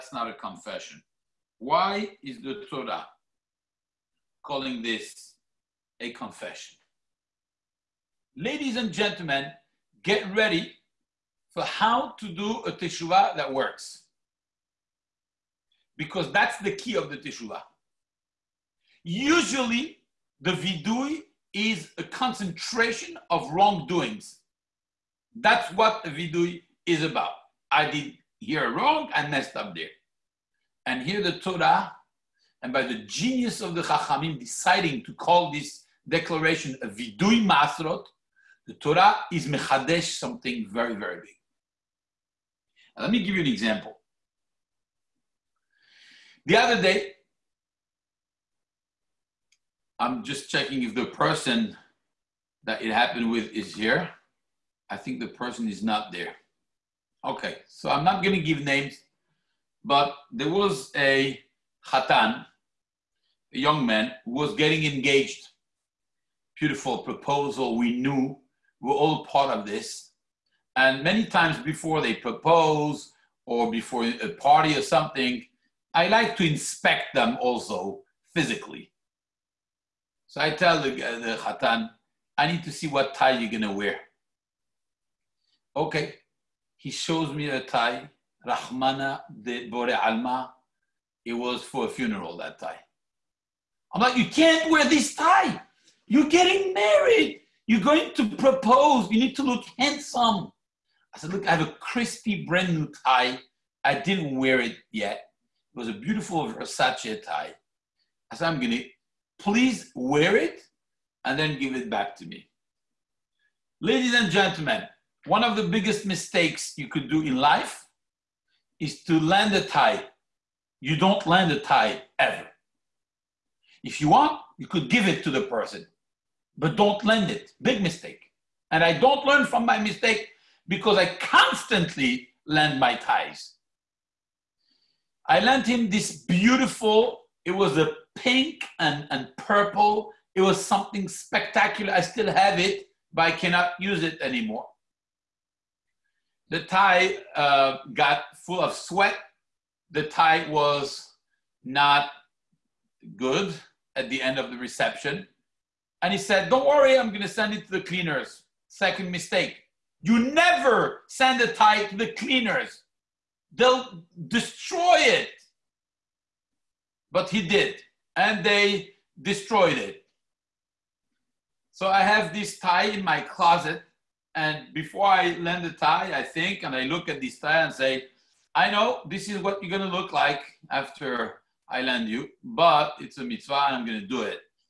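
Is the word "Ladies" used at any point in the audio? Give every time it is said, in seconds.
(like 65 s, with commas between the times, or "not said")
8 s, 113 s.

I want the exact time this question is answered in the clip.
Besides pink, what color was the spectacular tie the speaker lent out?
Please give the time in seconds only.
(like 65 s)
139 s.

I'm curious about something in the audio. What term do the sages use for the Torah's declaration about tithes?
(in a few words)
vidui masrot.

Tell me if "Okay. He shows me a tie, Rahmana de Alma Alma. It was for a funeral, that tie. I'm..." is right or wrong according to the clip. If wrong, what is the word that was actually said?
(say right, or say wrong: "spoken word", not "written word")
wrong: "Bore", not "Alma".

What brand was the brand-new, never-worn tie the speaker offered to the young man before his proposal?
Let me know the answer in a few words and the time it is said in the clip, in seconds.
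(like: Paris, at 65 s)
Versace, at 106 s.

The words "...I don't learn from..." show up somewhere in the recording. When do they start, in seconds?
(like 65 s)
128 s.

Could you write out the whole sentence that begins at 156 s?
And he said, Don't worry, I'm going to send it to the cleaners.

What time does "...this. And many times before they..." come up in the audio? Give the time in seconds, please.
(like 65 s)
69 s.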